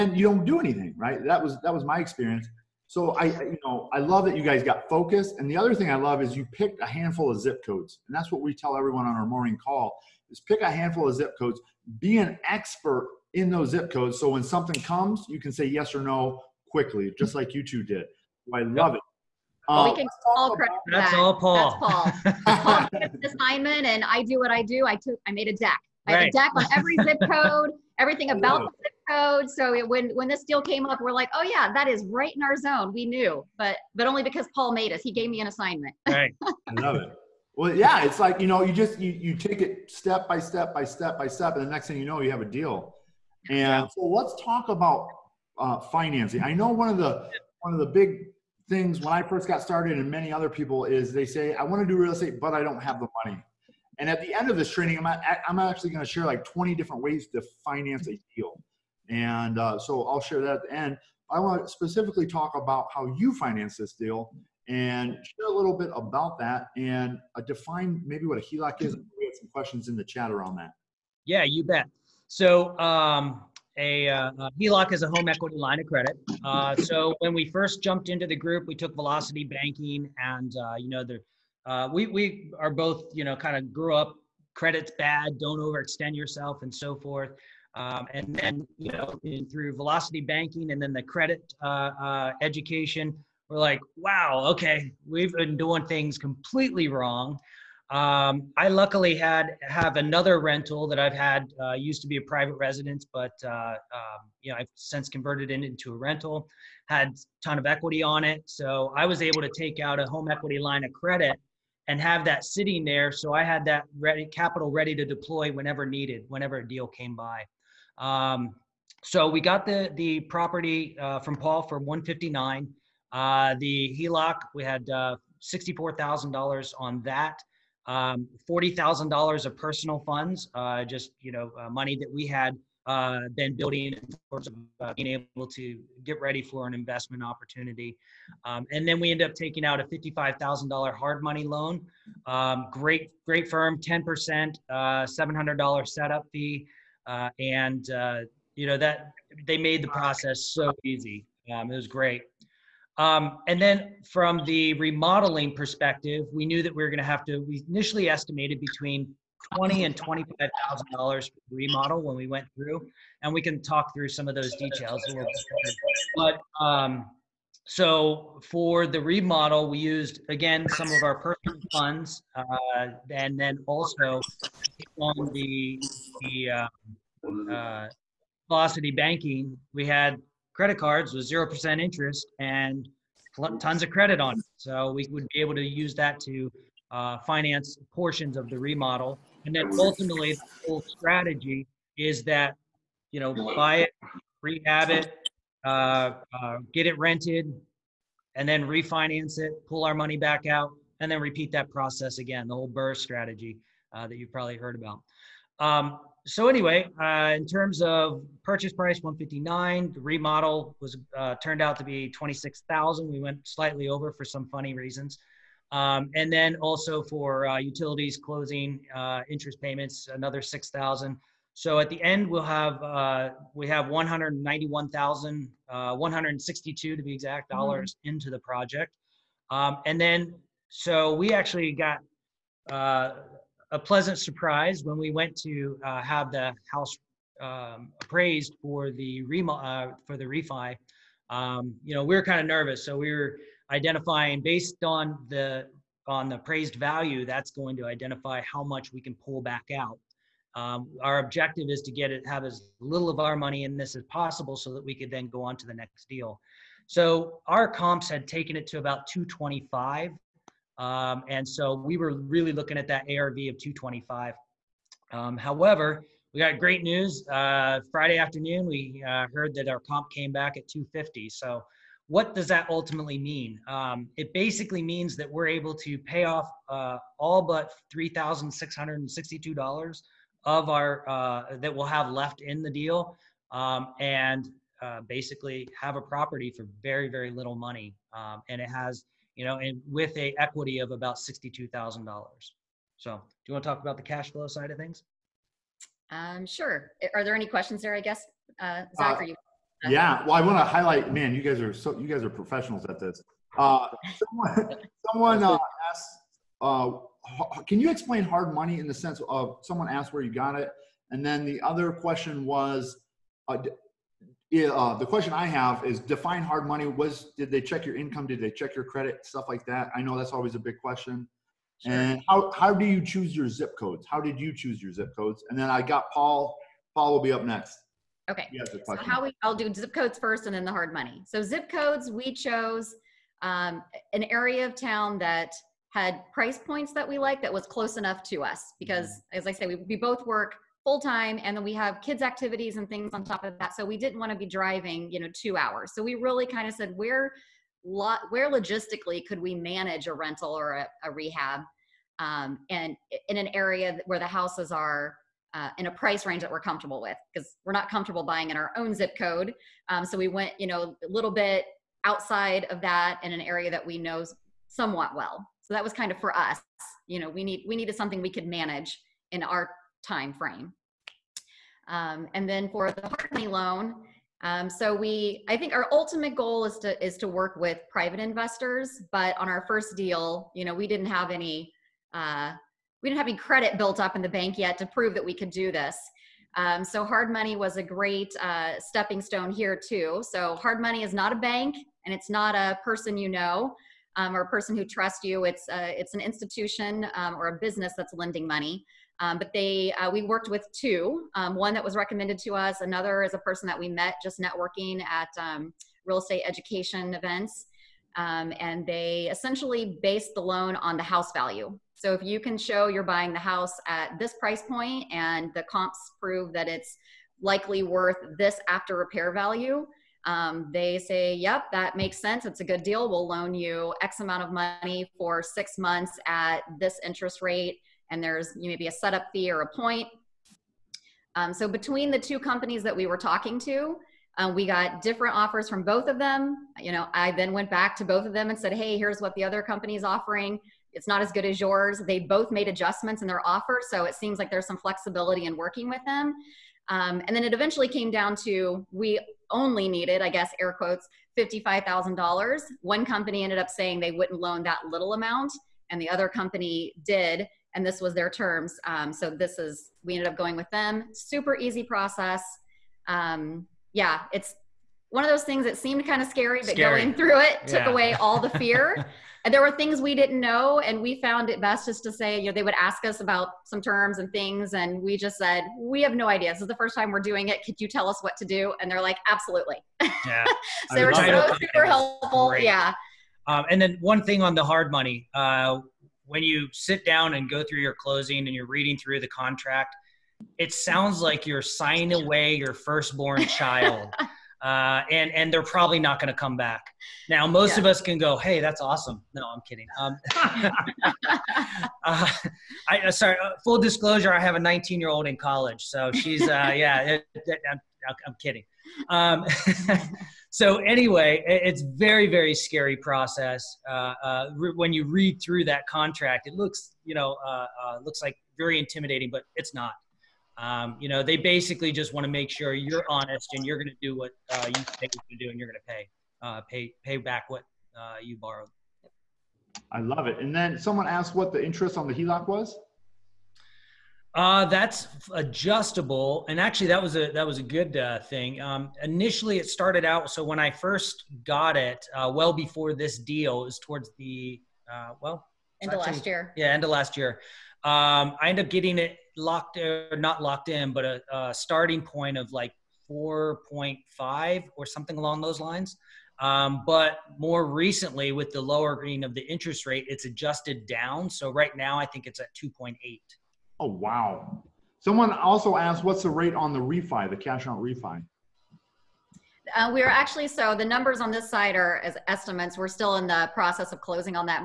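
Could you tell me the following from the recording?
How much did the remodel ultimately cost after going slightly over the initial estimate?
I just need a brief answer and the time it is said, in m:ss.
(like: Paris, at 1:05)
26,000, at 3:32.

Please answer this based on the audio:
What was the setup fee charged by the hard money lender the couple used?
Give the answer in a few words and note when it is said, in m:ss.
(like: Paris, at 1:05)
$700, at 2:25.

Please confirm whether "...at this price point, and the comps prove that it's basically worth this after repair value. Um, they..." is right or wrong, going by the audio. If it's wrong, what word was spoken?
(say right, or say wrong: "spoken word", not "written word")
wrong: "likely", not "basically".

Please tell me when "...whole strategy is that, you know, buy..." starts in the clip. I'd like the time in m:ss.
3:10.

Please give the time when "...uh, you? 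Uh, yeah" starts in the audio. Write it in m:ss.
4:59.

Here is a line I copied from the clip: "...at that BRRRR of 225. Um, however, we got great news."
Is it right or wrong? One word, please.
wrong.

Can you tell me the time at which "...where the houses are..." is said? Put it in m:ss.
5:54.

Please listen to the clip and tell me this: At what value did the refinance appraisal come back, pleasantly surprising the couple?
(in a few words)
250.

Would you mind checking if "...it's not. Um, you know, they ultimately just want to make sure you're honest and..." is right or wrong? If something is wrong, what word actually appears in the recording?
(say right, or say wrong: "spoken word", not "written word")
wrong: "basically", not "ultimately".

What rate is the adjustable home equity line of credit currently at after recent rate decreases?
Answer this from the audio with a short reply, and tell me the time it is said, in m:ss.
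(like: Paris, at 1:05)
2.8, at 9:22.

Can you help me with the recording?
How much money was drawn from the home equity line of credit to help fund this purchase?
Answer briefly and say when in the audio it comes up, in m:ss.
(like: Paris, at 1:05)
$64,000, at 2:05.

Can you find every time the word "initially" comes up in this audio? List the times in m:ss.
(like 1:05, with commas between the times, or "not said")
2:37, 8:59.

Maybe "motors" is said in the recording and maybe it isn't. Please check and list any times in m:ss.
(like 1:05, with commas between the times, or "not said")
not said.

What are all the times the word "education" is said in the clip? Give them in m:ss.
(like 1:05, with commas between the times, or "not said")
1:32, 6:46.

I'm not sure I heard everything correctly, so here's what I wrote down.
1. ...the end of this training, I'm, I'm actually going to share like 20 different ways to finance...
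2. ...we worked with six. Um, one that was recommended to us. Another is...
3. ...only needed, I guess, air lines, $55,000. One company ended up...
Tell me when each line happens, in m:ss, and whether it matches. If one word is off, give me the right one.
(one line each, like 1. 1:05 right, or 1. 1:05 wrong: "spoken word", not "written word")
1. 0:54 right
2. 6:40 wrong: "two", not "six"
3. 7:29 wrong: "quotes", not "lines".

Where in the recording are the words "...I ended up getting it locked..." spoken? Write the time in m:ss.
9:08.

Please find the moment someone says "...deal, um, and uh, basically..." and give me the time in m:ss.
4:42.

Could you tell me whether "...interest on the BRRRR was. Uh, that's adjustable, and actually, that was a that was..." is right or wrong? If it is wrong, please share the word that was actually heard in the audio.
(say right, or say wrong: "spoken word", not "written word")
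wrong: "HELOC", not "BRRRR".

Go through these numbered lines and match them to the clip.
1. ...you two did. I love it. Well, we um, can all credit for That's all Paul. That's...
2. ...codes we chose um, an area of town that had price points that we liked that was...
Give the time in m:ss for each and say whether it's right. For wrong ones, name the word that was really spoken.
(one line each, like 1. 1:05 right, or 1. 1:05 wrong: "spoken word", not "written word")
1. 0:17 right
2. 5:31 right.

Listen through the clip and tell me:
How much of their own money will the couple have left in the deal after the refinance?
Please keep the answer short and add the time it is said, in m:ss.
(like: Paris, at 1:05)
$3,662, at 4:37.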